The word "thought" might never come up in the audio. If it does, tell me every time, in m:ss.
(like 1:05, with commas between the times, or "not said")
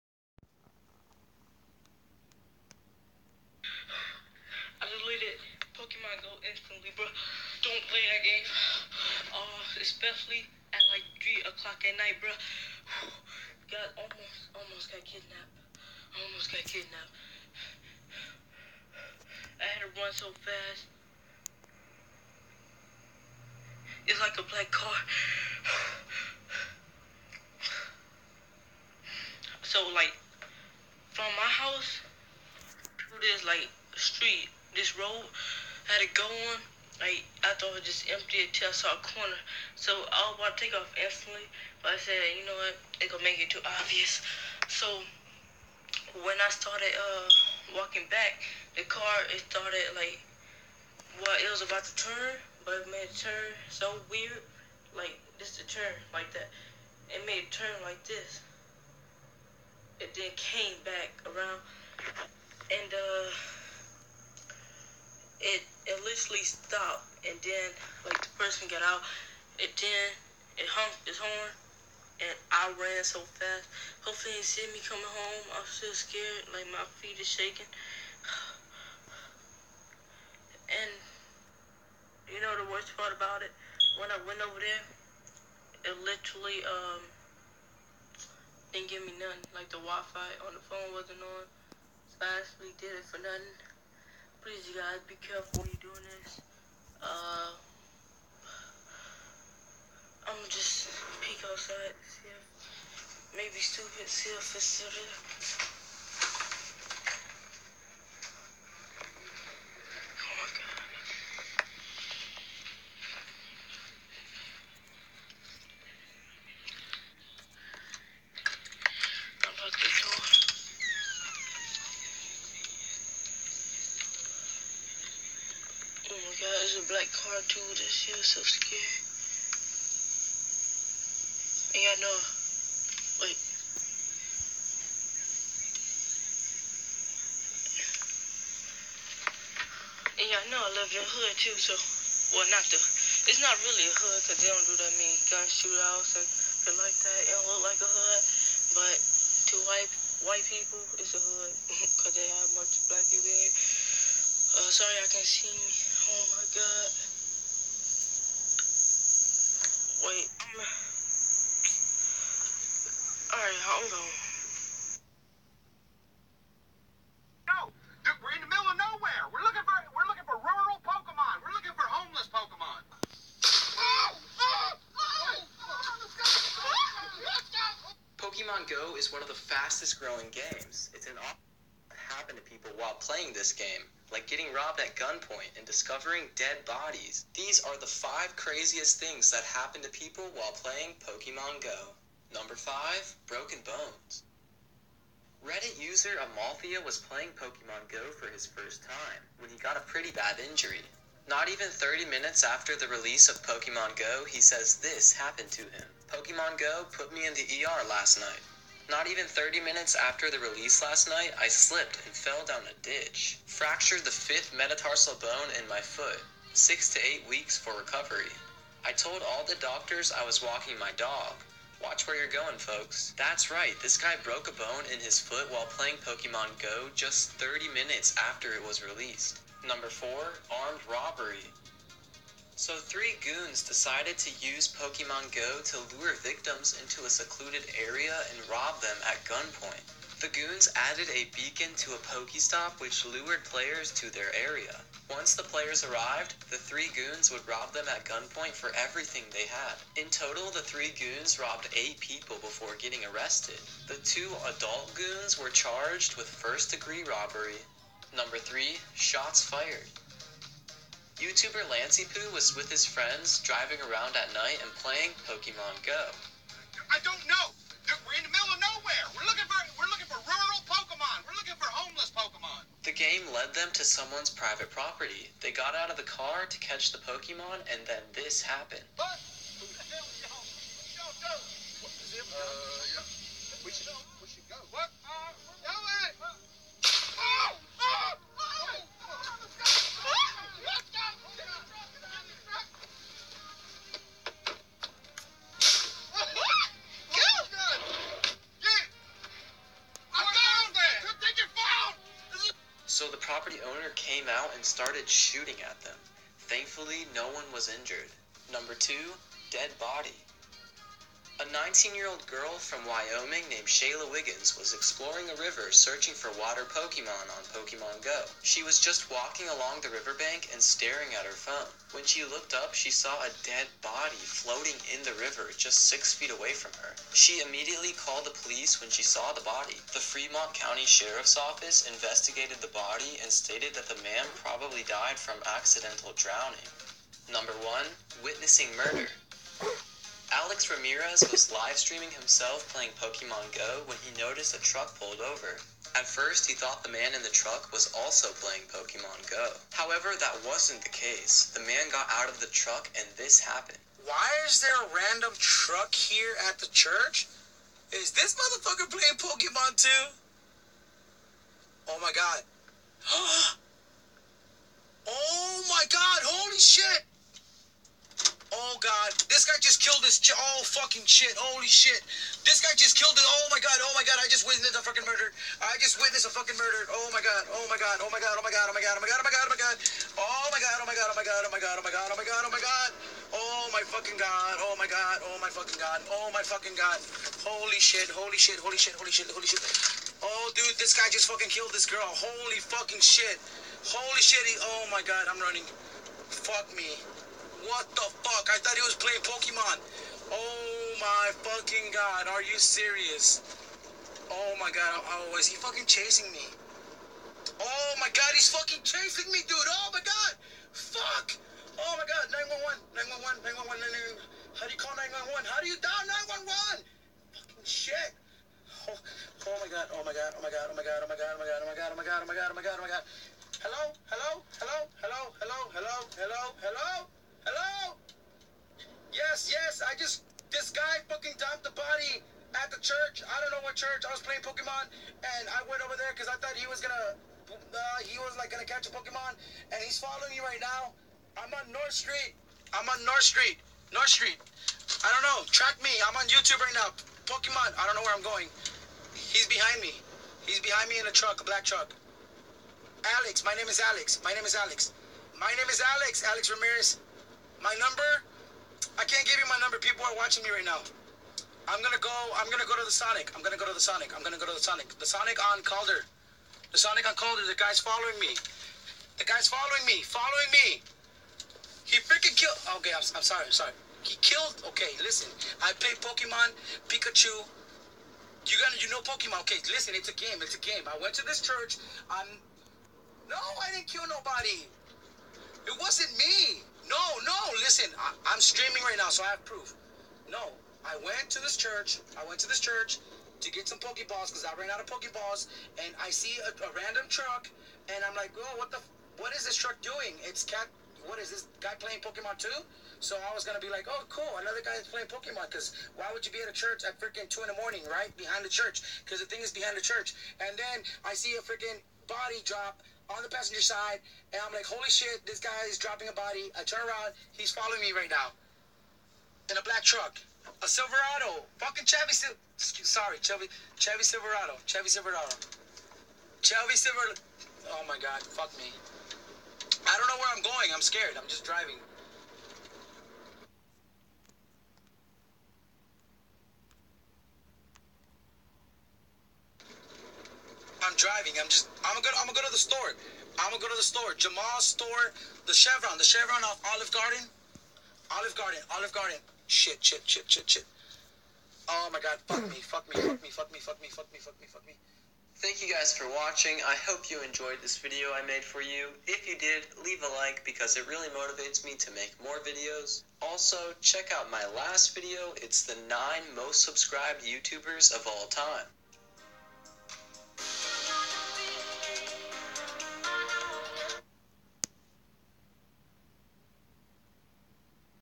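0:37, 5:46, 7:16.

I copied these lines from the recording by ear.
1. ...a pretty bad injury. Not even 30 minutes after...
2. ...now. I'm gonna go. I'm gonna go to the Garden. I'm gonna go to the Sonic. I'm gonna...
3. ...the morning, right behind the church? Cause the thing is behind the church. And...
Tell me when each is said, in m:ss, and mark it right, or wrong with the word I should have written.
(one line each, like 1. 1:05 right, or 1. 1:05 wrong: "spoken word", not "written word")
1. 3:19 right
2. 7:40 wrong: "Sonic", not "Garden"
3. 8:27 right.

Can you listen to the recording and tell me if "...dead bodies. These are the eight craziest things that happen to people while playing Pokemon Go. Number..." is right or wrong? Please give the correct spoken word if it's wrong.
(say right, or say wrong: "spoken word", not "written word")
wrong: "five", not "eight".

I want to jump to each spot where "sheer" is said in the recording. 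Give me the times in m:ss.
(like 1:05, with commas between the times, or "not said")
not said.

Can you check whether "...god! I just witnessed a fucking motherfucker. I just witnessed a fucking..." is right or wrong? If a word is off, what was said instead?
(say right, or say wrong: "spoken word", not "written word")
wrong: "murder", not "motherfucker".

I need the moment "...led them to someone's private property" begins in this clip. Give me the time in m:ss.
4:33.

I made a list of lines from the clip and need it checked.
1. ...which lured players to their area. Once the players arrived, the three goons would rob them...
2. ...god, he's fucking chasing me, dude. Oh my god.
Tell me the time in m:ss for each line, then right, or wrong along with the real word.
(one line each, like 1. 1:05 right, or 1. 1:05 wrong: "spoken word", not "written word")
1. 4:02 right
2. 6:48 right.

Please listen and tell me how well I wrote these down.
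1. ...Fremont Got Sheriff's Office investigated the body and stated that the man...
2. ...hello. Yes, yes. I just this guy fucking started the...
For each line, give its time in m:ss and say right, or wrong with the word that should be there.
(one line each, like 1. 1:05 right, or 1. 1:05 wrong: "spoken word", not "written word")
1. 5:29 wrong: "County", not "Got"
2. 7:07 wrong: "dumped", not "started".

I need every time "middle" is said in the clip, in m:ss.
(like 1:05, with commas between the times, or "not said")
2:48, 4:28.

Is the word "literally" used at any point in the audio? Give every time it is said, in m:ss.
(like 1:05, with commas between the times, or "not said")
1:06, 1:26.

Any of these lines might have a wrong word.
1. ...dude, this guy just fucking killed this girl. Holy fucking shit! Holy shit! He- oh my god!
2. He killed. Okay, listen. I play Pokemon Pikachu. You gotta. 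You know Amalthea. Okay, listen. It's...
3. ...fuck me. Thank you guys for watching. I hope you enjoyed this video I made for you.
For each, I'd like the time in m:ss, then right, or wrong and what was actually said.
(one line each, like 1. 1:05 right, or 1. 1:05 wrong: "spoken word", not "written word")
1. 6:30 right
2. 7:54 wrong: "Pokemon", not "Amalthea"
3. 9:14 right.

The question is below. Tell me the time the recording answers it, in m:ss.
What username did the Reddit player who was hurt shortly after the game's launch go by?
3:15.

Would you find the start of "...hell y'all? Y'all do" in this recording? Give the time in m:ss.
4:39.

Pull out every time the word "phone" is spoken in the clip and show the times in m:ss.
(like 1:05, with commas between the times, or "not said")
1:30, 5:21.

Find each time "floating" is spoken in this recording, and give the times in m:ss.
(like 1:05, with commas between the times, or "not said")
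5:24.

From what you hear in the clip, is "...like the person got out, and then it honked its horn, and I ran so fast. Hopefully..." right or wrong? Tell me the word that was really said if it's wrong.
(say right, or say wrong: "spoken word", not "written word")
right.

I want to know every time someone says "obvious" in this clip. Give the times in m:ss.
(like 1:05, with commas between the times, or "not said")
0:43.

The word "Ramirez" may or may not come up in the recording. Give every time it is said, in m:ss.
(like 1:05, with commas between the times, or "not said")
5:40, 7:36.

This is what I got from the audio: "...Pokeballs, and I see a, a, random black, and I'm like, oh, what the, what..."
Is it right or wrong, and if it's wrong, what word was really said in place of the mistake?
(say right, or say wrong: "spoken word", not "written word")
wrong: "truck", not "black".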